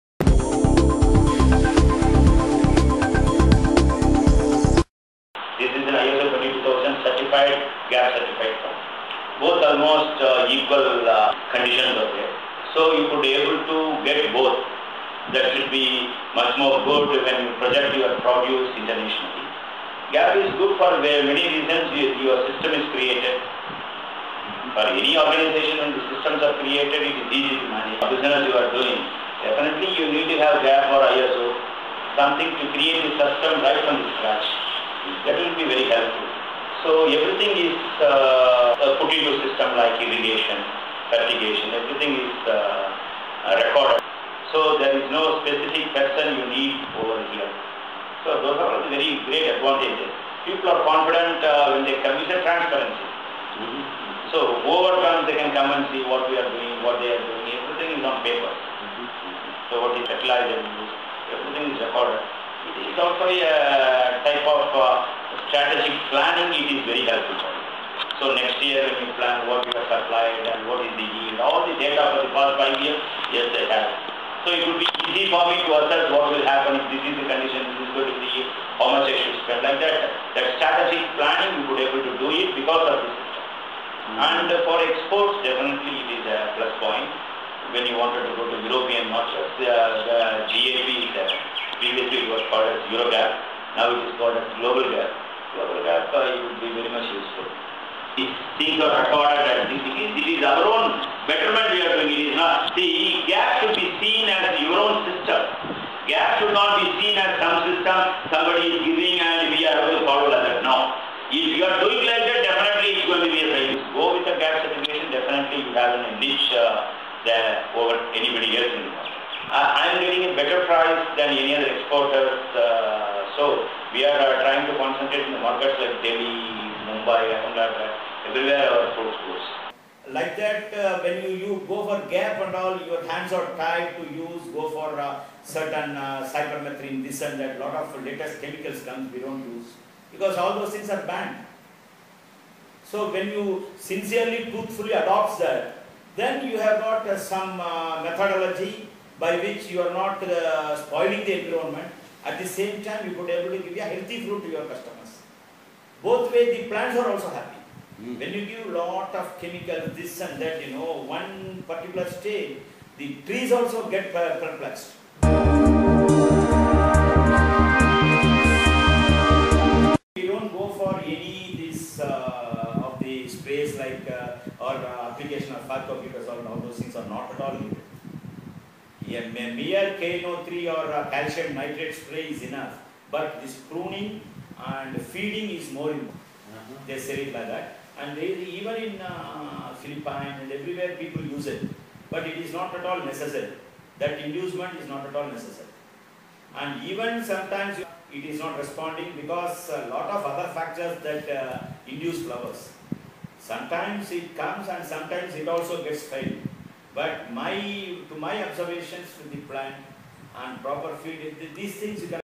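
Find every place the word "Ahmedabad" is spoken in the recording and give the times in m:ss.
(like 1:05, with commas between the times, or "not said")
2:07.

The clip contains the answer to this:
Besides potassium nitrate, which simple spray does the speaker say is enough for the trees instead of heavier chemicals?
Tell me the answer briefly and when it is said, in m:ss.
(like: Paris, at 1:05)
calcium nitrate, at 3:01.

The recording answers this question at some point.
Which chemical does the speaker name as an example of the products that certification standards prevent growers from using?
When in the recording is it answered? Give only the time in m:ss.
2:16.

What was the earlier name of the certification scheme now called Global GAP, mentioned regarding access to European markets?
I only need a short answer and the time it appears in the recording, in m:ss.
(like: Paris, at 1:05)
Eurogap, at 1:32.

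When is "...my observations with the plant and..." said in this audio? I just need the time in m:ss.
3:28.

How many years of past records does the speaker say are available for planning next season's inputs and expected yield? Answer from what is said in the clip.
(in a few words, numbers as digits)
5.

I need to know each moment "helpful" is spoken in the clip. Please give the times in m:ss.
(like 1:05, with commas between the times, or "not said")
0:35, 1:07.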